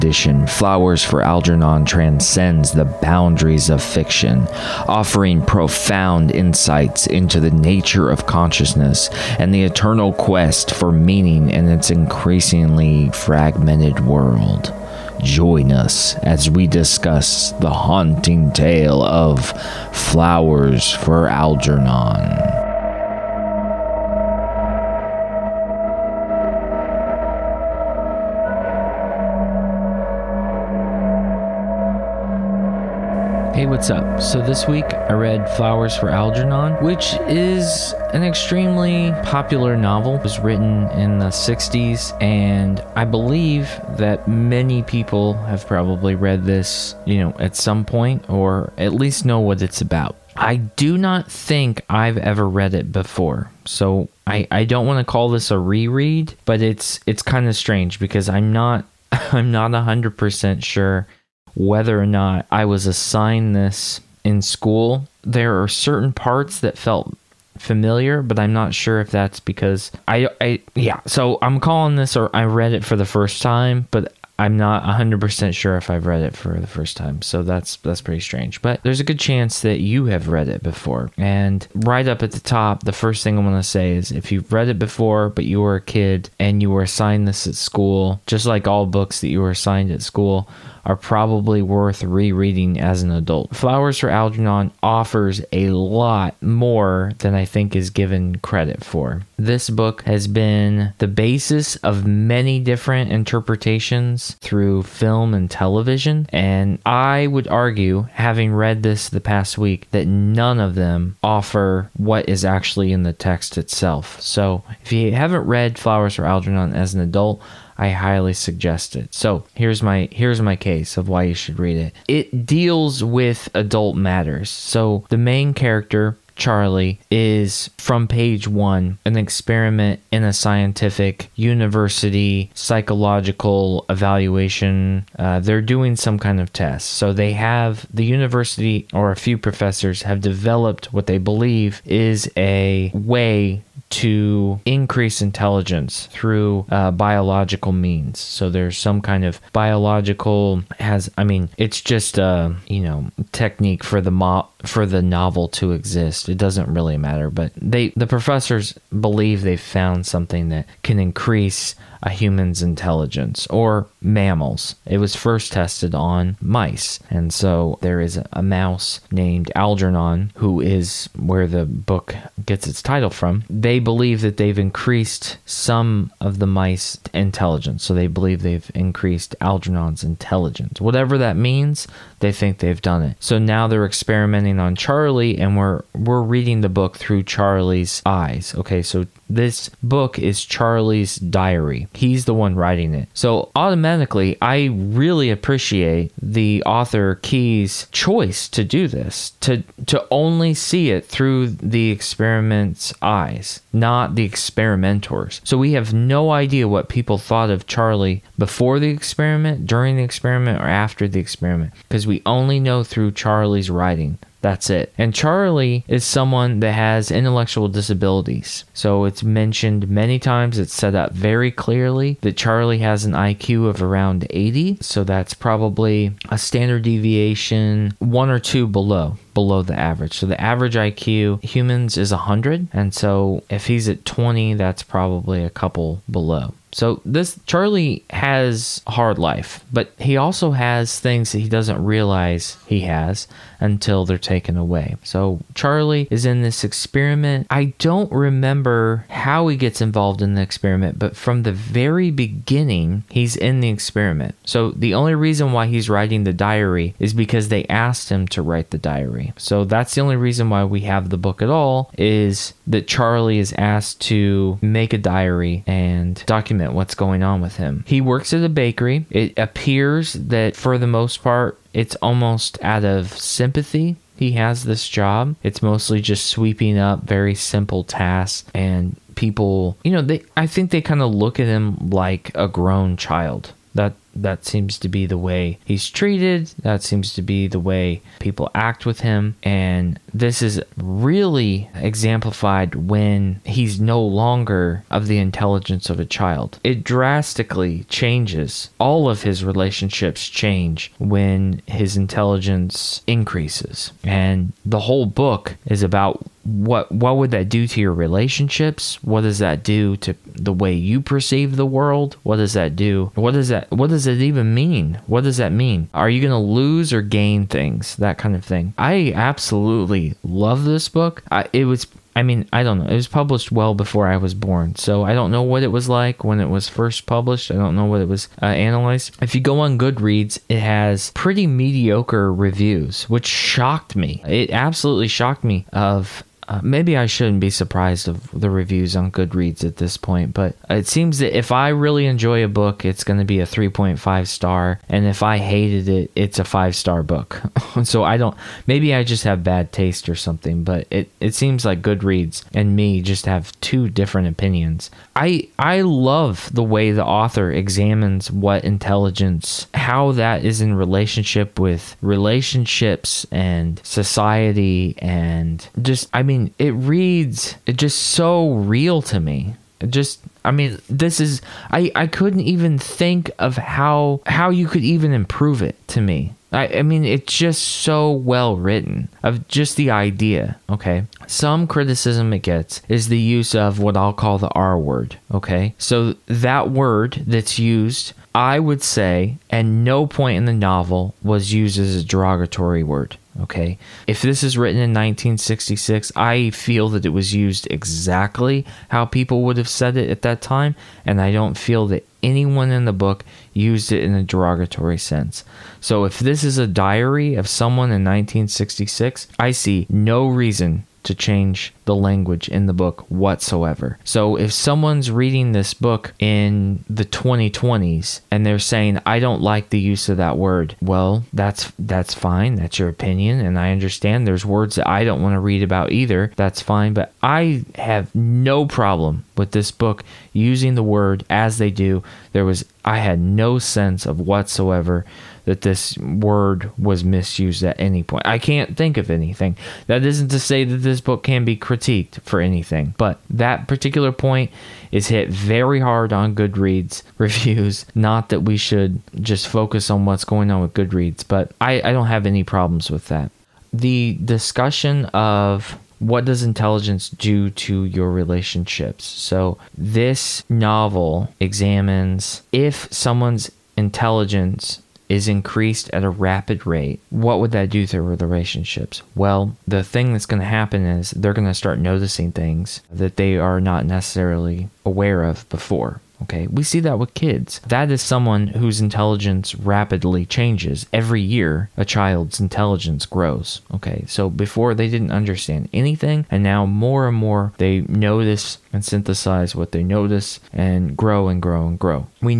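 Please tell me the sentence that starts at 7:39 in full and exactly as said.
So, this novel examines if someone's intelligence is increased at a rapid rate, what would that do to relationships?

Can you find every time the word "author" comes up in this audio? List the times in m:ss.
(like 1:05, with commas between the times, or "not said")
3:16, 5:57.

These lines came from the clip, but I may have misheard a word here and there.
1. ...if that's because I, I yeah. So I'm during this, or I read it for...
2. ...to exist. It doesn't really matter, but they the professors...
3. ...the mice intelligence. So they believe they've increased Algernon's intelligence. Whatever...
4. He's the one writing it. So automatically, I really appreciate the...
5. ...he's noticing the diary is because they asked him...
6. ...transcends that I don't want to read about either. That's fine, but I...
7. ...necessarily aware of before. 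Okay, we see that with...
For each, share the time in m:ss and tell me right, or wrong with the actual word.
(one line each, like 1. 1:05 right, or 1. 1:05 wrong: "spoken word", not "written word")
1. 1:08 wrong: "calling", not "during"
2. 2:35 right
3. 2:56 right
4. 3:11 right
5. 4:15 wrong: "writing", not "noticing"
6. 7:04 wrong: "words", not "transcends"
7. 7:53 right.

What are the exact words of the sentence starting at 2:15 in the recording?
Uh, they're doing some kind of test.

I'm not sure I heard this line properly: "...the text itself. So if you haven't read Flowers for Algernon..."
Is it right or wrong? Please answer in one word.
right.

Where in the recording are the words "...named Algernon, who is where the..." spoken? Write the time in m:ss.
2:49.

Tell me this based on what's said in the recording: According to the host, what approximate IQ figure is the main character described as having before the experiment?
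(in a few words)
80.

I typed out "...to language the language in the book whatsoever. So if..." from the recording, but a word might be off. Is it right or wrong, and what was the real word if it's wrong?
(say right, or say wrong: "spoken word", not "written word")
wrong: "change", not "language".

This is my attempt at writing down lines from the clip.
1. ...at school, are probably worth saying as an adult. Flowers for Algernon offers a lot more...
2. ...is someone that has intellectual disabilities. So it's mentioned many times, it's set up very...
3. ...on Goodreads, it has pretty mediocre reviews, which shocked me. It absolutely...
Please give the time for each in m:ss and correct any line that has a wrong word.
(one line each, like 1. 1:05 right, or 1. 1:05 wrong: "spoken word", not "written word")
1. 1:29 wrong: "rereading", not "saying"
2. 3:35 right
3. 5:29 right.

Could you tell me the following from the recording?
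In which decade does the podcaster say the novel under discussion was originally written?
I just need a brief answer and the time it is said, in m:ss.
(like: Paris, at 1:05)
the 60s, at 0:41.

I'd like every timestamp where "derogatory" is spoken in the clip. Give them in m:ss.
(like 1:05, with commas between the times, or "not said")
6:32, 6:44.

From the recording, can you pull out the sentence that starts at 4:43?
That that seems to be the way he's treated.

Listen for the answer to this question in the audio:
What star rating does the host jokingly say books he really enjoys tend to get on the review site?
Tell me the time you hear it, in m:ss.
5:43.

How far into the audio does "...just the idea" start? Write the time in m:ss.
6:19.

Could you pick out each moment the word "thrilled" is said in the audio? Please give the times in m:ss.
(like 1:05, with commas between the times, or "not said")
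not said.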